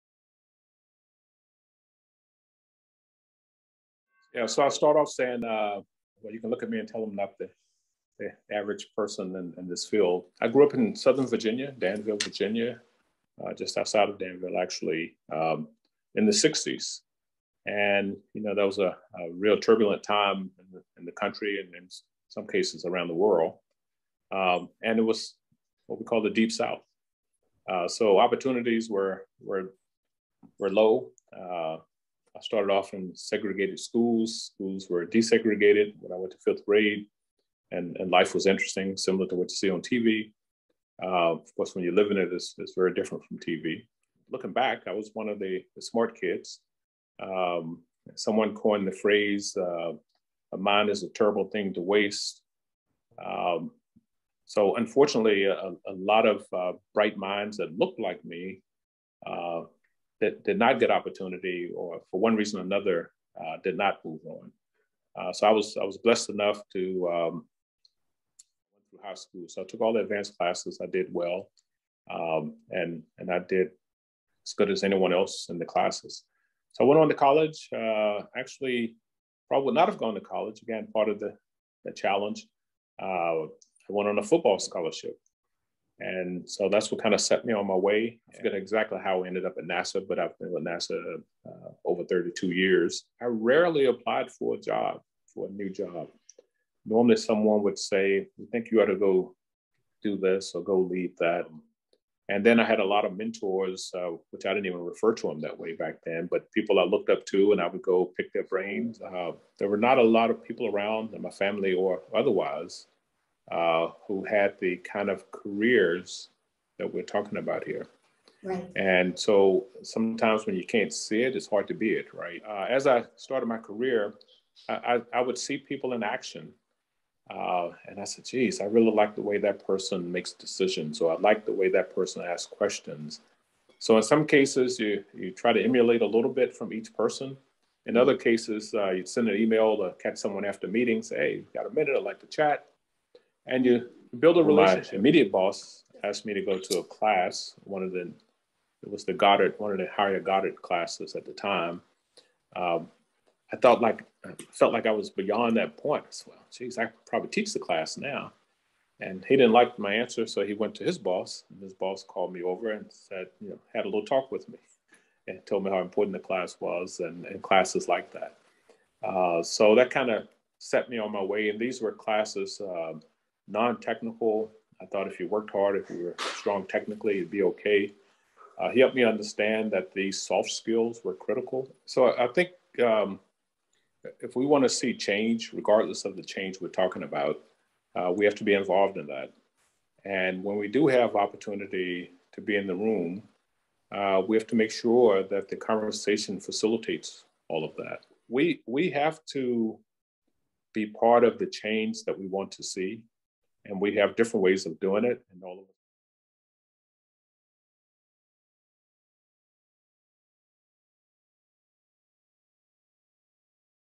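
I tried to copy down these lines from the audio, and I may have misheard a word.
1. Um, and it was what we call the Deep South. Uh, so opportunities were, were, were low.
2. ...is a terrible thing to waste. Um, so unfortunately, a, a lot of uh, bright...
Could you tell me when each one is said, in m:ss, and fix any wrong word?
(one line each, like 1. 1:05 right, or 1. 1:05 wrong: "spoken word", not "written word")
1. 0:24 right
2. 0:50 right.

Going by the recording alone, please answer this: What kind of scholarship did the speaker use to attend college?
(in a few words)
Football scholarship.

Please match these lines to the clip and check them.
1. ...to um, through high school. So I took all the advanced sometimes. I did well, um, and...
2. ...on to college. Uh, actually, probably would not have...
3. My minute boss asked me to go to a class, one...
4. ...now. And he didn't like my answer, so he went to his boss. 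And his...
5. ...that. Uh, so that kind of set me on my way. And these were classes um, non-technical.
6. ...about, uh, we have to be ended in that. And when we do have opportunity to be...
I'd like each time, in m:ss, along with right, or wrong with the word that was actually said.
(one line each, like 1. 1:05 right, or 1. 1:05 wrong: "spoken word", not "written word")
1. 1:06 wrong: "classes", not "sometimes"
2. 1:17 right
3. 2:24 wrong: "immediate", not "minute"
4. 2:37 right
5. 2:48 right
6. 3:07 wrong: "involved", not "ended".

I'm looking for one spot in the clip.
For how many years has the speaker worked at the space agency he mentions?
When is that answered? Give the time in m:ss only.
1:31.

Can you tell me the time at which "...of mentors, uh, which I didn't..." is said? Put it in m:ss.
1:43.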